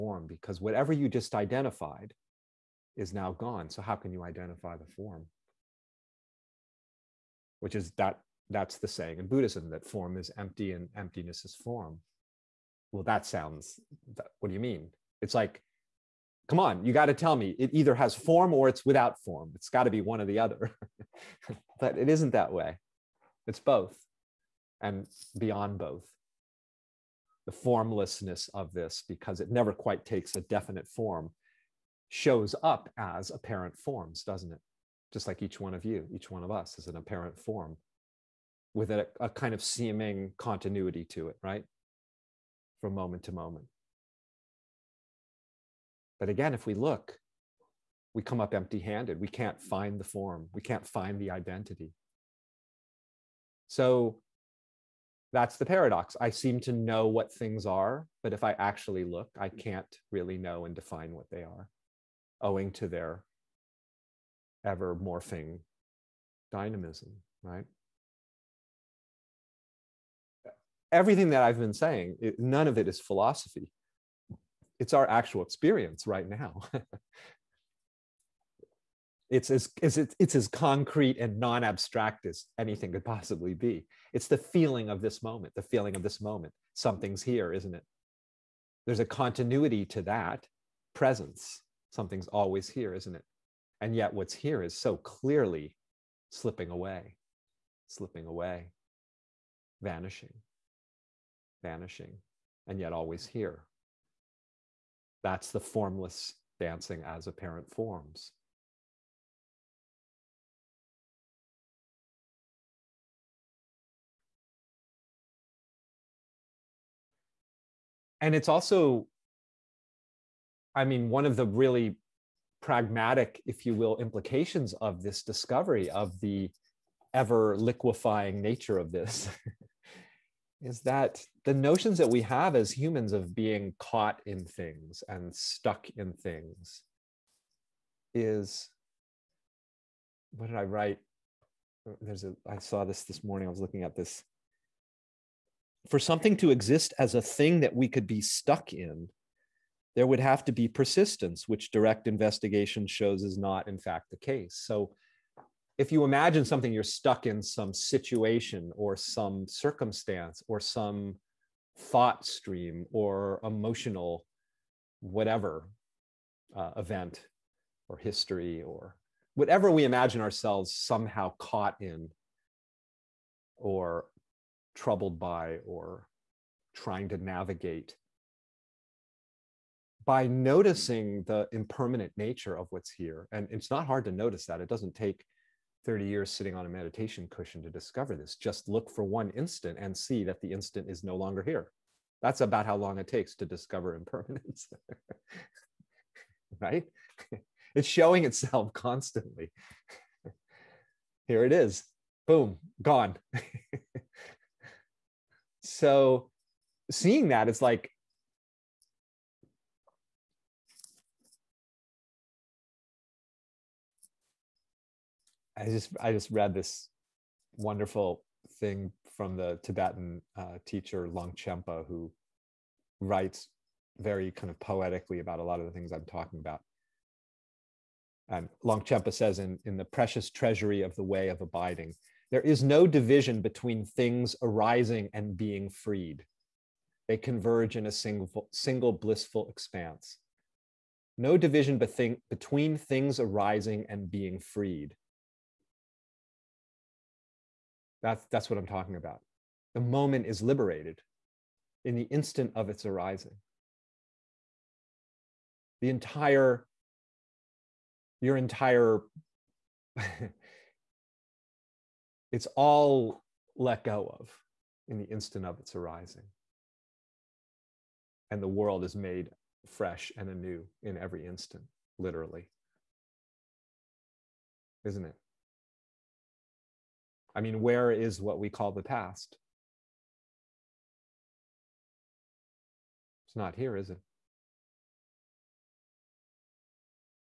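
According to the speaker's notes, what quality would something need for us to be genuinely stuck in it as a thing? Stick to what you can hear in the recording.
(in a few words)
persistence.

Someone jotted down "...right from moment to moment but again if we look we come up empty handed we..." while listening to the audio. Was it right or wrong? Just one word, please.
right.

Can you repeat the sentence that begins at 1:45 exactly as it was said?
That's the formless dancing as apparent forms.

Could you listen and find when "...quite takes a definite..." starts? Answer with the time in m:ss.
0:29.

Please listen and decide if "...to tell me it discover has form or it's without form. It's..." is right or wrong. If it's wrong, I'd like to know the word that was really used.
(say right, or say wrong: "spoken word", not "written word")
wrong: "either", not "discover".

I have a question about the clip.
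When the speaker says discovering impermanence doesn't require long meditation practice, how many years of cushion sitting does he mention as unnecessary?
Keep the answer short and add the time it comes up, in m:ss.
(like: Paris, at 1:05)
30, at 3:05.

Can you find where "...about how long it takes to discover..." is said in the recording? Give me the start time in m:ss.
3:12.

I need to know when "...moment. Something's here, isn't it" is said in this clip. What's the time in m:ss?
1:26.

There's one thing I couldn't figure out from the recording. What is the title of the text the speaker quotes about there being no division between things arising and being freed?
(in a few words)
The Precious Treasury of the Way of Abiding.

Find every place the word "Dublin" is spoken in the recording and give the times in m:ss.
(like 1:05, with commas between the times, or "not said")
not said.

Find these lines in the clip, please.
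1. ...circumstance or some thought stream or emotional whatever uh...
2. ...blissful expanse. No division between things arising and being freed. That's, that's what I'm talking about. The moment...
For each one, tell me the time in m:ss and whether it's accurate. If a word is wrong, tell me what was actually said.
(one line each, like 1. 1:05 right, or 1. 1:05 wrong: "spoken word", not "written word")
1. 2:39 right
2. 3:58 right.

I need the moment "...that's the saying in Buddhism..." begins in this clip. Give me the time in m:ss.
0:08.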